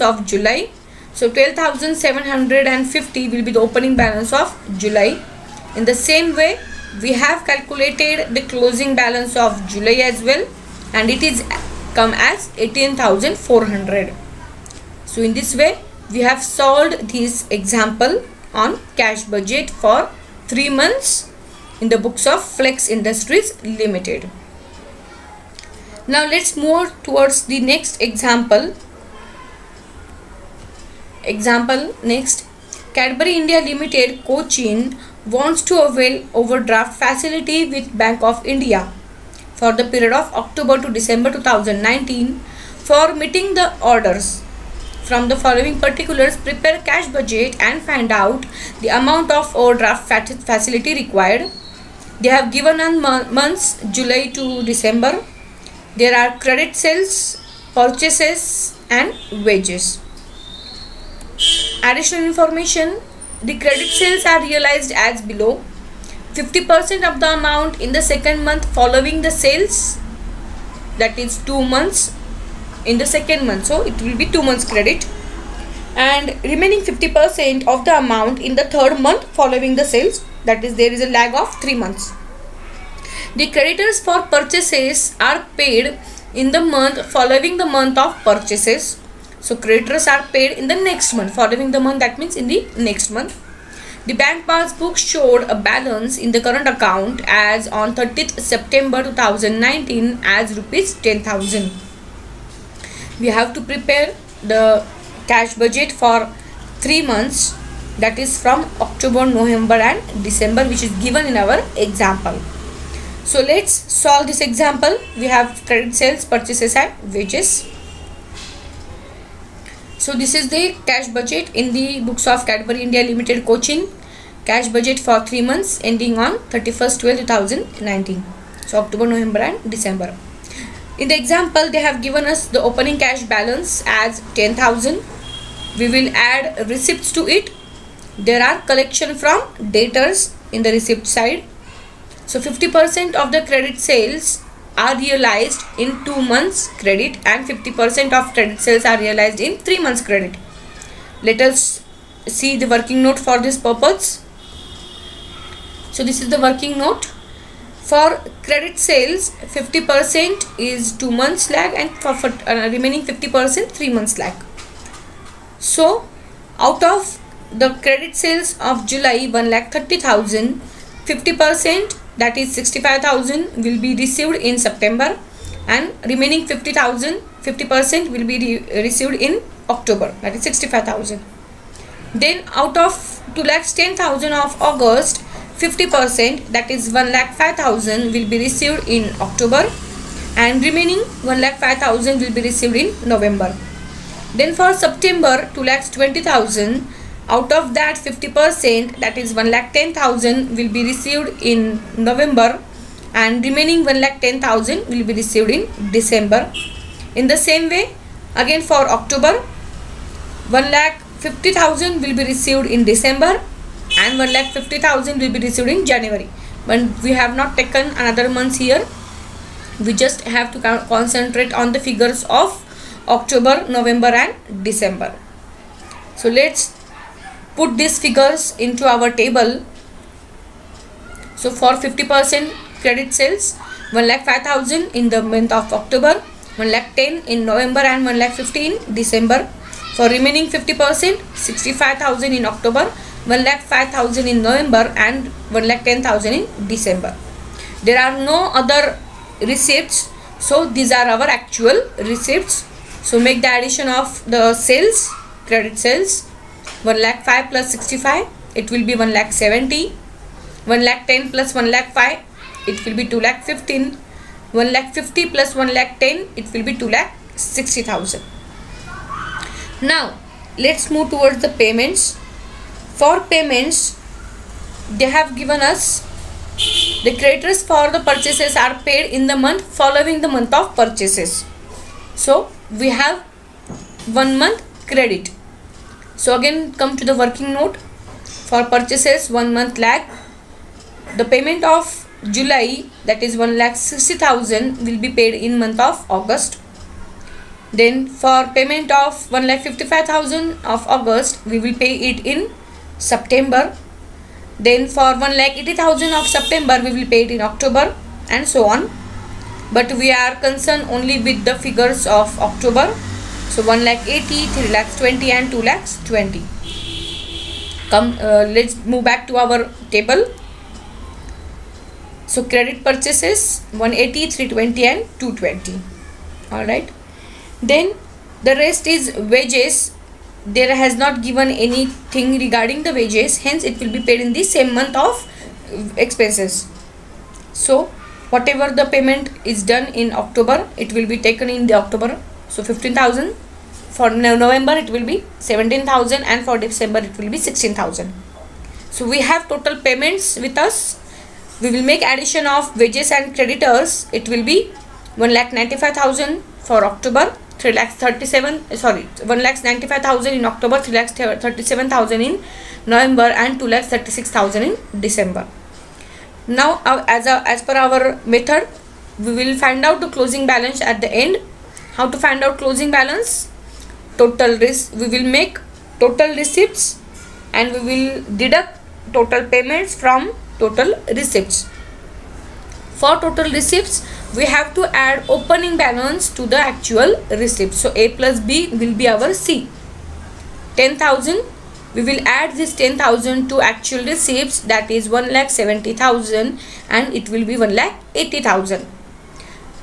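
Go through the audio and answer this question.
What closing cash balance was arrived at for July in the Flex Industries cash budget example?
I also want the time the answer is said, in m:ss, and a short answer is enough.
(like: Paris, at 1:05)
18,400, at 0:12.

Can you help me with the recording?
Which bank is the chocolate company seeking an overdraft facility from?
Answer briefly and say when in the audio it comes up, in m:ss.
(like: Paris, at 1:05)
Bank of India, at 0:38.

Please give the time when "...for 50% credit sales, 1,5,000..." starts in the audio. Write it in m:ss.
3:51.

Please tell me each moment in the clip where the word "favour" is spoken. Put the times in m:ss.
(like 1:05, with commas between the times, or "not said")
not said.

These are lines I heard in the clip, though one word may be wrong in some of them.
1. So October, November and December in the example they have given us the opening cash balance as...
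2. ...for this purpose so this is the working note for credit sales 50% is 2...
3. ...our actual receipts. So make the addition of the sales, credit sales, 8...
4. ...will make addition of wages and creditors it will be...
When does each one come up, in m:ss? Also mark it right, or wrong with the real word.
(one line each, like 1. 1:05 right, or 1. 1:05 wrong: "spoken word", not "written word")
1. 2:08 right
2. 2:33 right
3. 4:11 wrong: "1", not "8"
4. 5:51 right.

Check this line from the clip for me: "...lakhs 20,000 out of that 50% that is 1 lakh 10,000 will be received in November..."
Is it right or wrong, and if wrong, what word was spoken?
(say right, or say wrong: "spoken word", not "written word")
right.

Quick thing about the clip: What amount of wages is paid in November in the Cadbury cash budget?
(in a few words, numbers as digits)
17,000.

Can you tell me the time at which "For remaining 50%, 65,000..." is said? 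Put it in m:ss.
3:59.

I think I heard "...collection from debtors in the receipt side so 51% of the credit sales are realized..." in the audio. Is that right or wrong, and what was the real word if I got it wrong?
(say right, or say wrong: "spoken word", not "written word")
wrong: "50", not "51".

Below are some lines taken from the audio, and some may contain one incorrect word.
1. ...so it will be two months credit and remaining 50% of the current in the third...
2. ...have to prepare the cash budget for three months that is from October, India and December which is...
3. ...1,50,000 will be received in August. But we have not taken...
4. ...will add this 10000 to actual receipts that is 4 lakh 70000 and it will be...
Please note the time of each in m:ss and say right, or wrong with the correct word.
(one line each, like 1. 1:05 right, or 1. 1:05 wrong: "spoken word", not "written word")
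1. 1:13 wrong: "amount", not "current"
2. 1:43 wrong: "November", not "India"
3. 3:34 wrong: "January", not "August"
4. 6:32 wrong: "1", not "4".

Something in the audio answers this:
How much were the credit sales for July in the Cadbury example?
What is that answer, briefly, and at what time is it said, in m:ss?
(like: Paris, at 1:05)
1,30,000, at 2:49.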